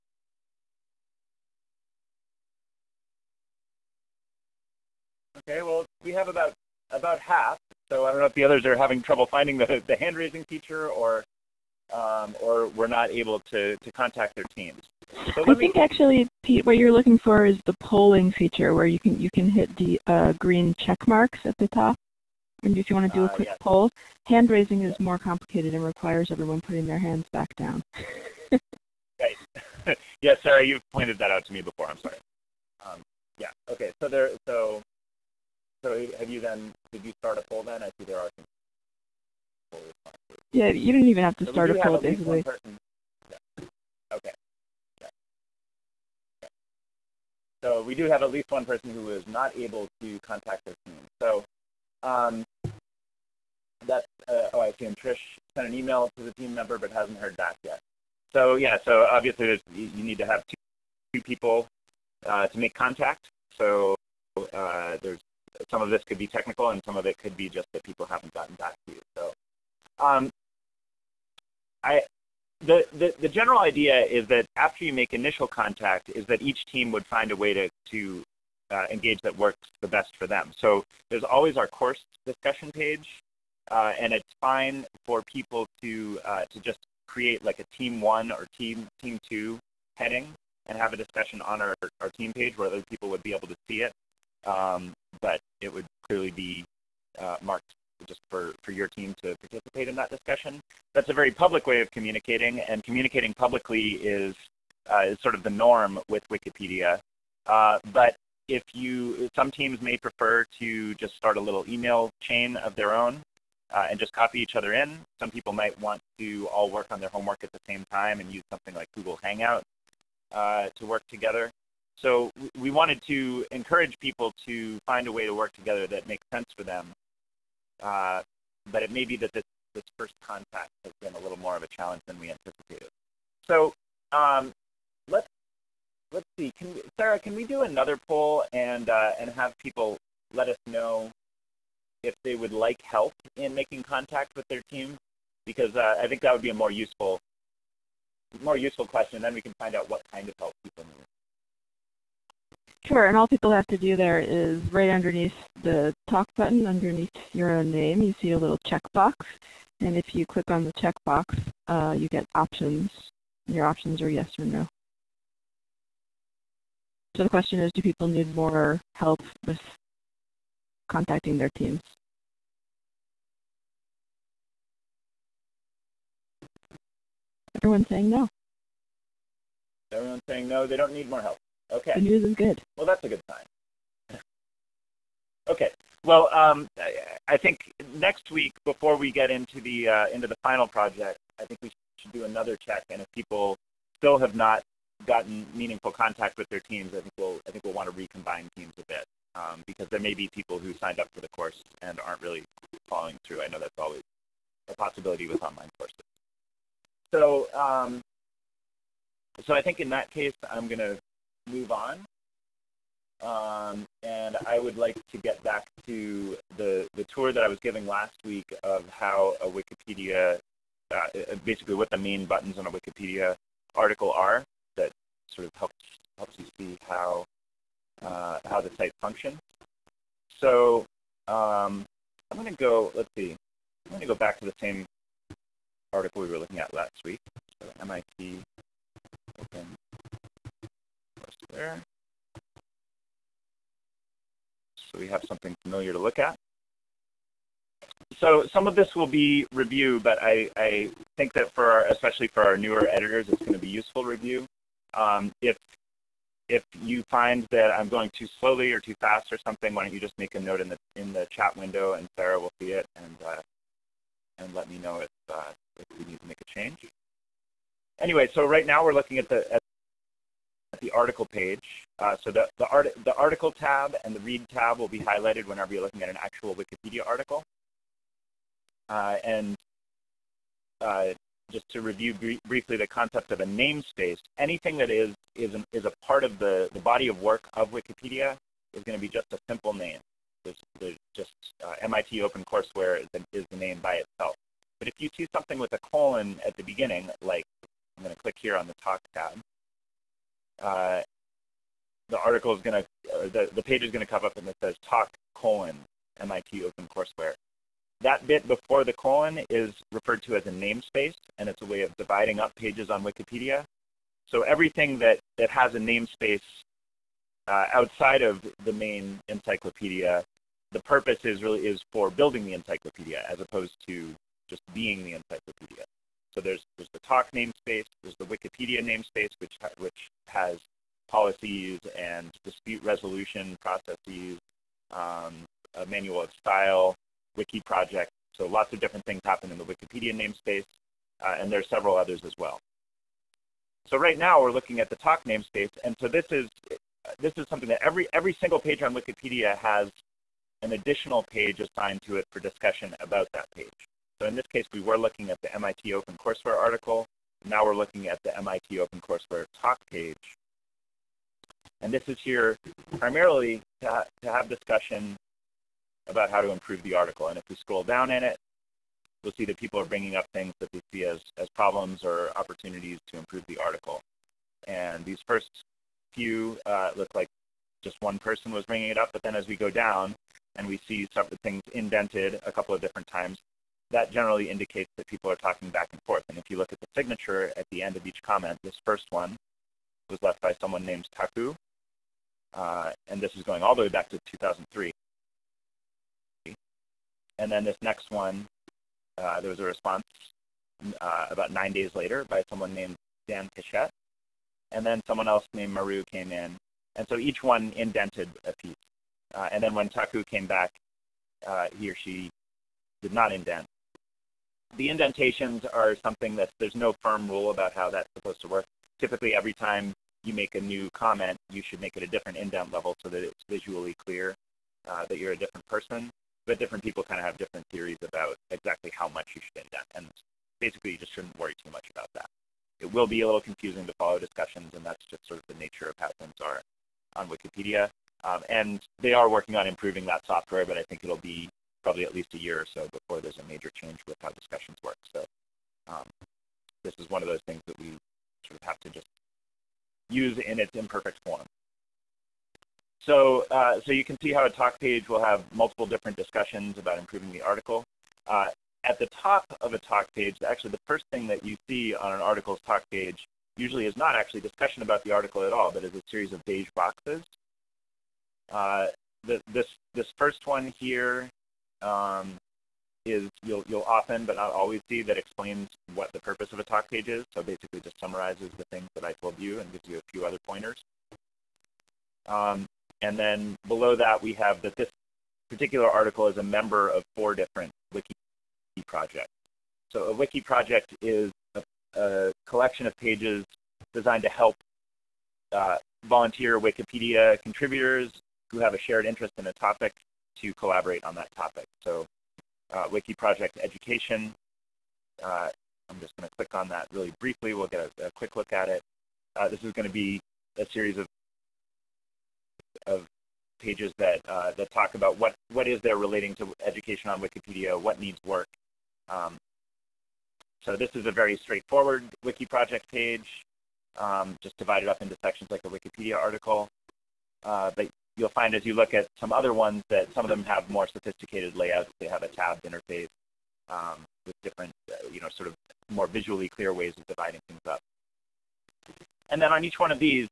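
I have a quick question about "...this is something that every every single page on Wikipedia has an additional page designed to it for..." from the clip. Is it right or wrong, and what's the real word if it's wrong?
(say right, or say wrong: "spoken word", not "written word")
wrong: "assigned", not "designed".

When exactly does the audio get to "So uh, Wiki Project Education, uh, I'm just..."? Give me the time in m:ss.
8:21.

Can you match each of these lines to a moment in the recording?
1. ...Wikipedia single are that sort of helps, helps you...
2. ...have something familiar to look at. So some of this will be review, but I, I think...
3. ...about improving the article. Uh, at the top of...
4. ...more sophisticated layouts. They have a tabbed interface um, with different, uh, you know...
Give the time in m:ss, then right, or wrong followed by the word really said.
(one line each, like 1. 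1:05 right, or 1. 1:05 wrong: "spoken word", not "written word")
1. 3:42 wrong: "article", not "single"
2. 4:05 right
3. 7:36 right
4. 8:50 right.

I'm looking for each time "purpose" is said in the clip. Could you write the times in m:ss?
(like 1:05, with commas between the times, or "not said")
5:20, 7:56.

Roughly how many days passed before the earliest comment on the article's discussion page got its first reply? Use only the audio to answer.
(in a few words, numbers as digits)
9.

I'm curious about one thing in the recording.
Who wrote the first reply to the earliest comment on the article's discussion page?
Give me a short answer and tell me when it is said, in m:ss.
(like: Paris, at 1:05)
Dan Pichette, at 6:43.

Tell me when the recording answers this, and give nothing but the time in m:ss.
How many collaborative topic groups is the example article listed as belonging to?
8:07.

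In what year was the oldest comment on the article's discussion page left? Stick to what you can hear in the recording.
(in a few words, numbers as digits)
2003.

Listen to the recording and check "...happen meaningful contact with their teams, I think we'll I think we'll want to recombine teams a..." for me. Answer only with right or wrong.
wrong.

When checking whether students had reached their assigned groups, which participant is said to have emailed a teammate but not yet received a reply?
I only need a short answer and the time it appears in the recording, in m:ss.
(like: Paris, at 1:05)
Trish, at 0:54.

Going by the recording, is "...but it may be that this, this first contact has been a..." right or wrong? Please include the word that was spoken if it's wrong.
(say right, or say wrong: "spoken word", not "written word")
right.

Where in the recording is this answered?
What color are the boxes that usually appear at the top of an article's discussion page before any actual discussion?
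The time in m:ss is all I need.
7:46.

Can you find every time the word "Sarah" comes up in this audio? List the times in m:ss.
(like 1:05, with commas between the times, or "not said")
0:30, 2:16, 4:22.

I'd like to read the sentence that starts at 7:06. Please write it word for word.
But different people kind of have different theories about exactly how much you should indent.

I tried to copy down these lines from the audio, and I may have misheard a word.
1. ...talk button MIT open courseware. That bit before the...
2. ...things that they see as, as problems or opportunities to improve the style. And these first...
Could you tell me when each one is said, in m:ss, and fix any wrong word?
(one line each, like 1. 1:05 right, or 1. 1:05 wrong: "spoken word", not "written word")
1. 5:04 wrong: "colon", not "button"
2. 6:10 wrong: "article", not "style".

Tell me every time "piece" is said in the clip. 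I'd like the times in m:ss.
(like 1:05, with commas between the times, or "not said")
6:48.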